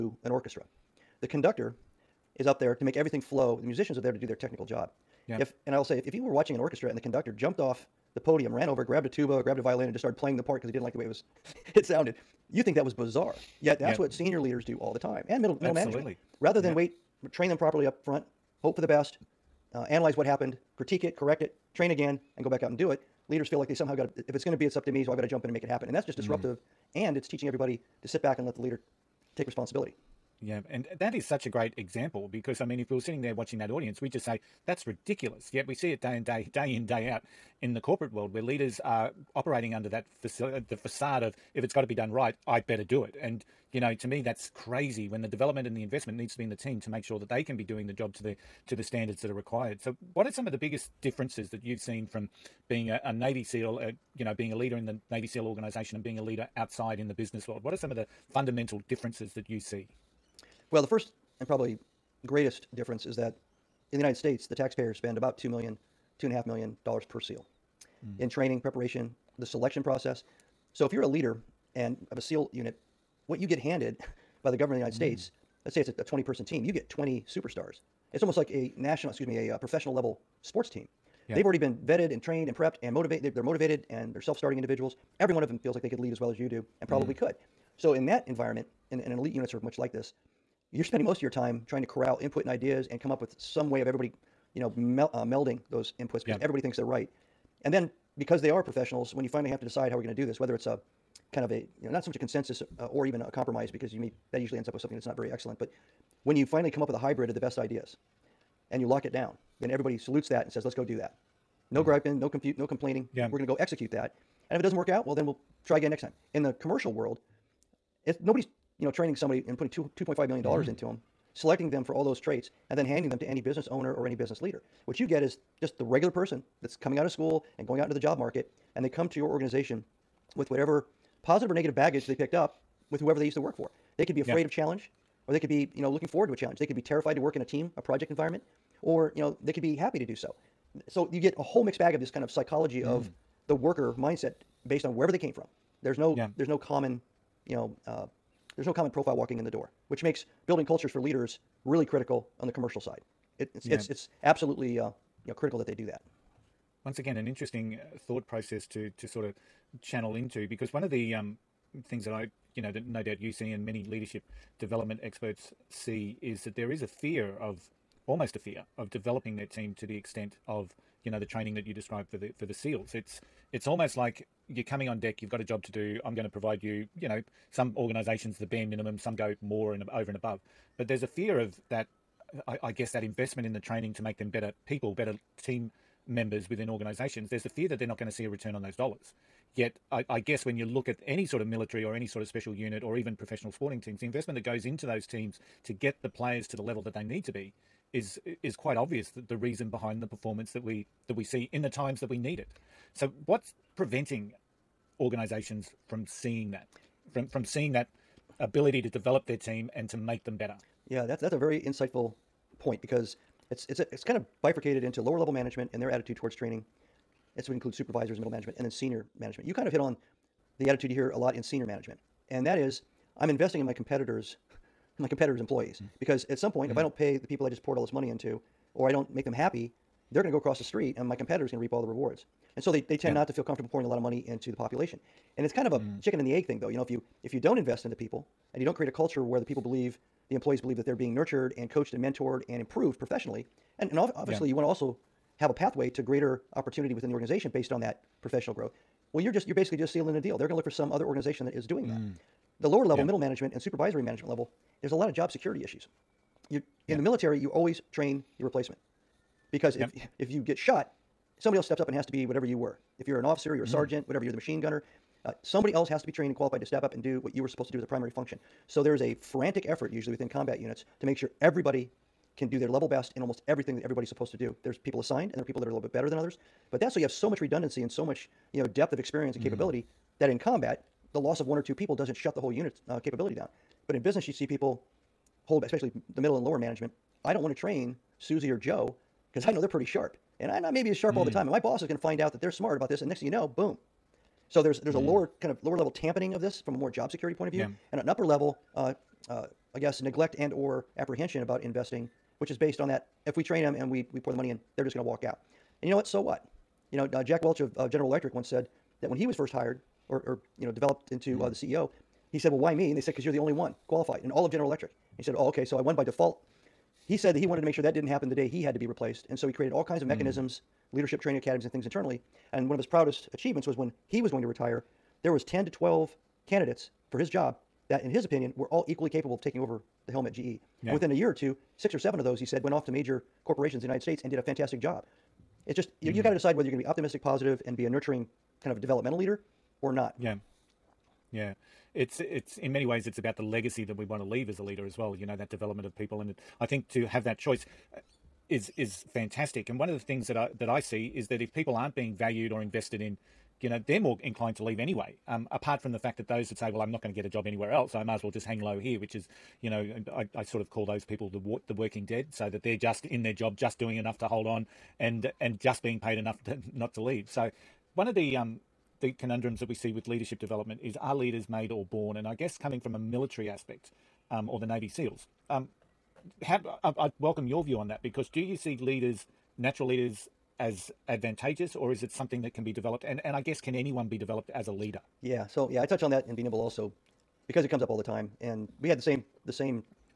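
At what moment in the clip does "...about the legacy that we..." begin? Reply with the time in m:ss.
5:43.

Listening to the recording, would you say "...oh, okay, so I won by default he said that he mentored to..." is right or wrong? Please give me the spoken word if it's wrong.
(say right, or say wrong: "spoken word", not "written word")
wrong: "wanted", not "mentored".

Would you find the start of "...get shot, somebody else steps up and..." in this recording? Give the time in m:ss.
4:20.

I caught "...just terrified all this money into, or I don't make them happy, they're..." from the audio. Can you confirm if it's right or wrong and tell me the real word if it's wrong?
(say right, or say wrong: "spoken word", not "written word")
wrong: "poured", not "terrified".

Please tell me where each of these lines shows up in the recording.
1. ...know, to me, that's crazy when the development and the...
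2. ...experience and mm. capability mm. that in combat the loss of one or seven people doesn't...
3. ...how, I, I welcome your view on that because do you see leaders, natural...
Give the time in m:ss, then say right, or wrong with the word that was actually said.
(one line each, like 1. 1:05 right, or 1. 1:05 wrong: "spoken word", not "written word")
1. 0:43 right
2. 4:38 wrong: "two", not "seven"
3. 6:16 right.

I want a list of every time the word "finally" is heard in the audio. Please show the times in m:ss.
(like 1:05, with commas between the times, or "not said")
1:39, 1:46.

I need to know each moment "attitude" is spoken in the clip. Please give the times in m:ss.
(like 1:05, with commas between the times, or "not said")
3:35, 3:40.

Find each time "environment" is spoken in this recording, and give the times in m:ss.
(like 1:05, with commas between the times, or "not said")
1:28, 2:18.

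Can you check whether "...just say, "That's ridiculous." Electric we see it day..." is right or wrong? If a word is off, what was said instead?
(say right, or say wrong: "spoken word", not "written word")
wrong: "Yet", not "Electric".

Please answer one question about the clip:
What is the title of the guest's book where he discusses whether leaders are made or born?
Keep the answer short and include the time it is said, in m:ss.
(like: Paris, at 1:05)
Be Nimble, at 6:26.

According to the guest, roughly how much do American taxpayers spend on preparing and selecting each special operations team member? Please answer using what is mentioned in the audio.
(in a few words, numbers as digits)
$2-2.5 million.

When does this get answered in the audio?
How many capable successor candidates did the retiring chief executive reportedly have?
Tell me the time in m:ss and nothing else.
5:25.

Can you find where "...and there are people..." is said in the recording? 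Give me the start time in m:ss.
4:35.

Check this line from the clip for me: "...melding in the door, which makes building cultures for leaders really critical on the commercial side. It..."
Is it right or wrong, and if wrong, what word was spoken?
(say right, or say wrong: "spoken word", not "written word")
wrong: "walking", not "melding".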